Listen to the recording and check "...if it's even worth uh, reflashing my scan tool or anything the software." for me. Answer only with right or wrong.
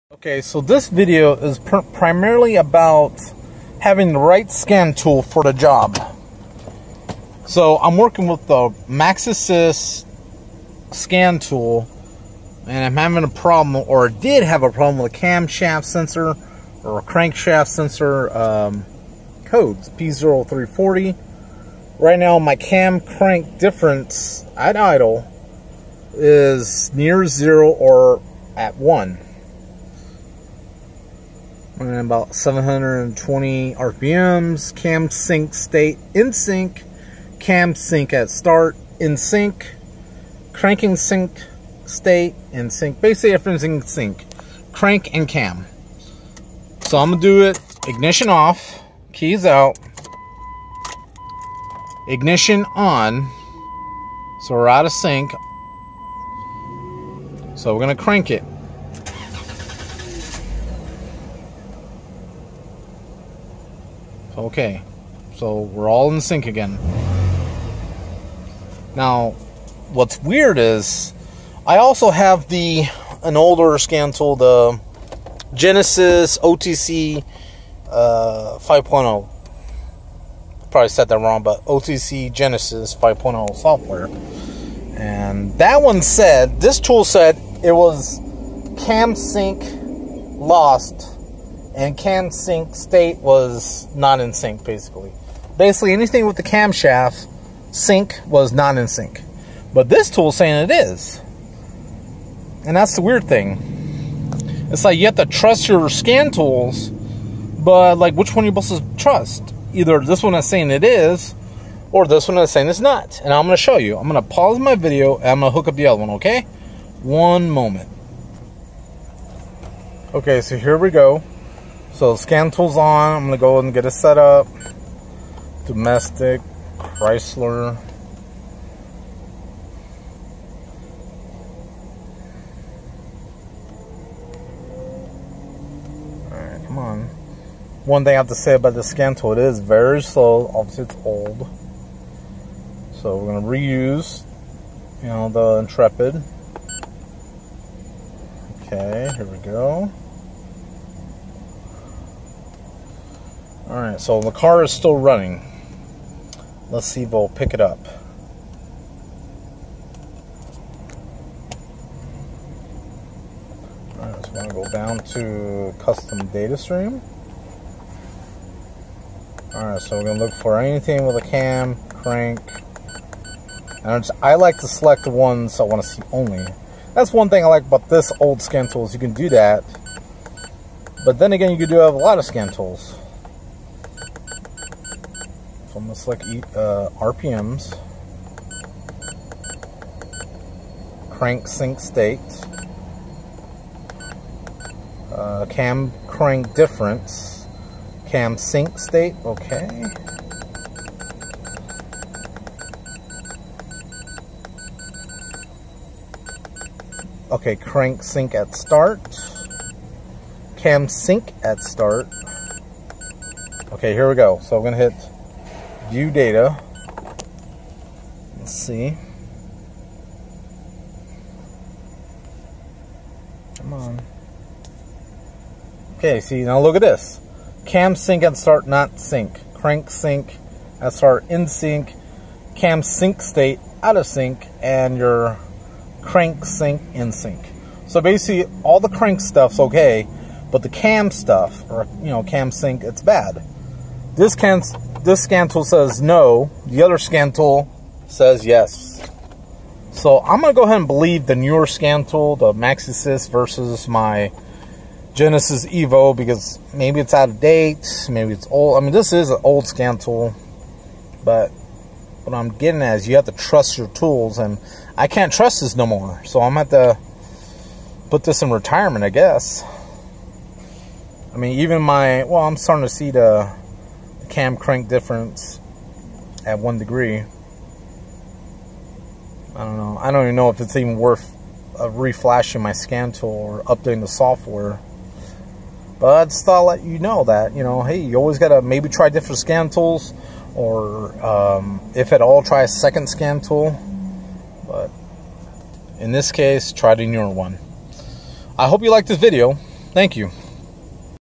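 wrong.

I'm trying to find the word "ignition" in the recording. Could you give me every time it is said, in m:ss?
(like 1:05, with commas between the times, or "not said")
0:47, 0:52.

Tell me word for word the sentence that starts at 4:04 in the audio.
This can't this scan tool says no, the other scan tool says yes.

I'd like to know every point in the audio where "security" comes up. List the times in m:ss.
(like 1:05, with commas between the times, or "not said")
not said.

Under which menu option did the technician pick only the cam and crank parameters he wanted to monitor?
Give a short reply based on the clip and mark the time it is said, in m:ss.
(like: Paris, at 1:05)
custom data stream, at 2:45.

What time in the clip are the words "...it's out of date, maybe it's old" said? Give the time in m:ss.
4:16.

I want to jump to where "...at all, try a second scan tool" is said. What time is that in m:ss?
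4:52.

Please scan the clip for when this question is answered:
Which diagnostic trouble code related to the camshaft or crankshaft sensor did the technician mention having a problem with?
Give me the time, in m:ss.
0:19.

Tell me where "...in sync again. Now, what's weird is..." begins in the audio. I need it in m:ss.
1:06.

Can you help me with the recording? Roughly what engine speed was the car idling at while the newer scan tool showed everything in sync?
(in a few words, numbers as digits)
720 RPM.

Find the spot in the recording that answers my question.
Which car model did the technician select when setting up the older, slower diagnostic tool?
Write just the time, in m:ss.
2:25.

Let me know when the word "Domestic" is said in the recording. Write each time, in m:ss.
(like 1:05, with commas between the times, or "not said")
2:05.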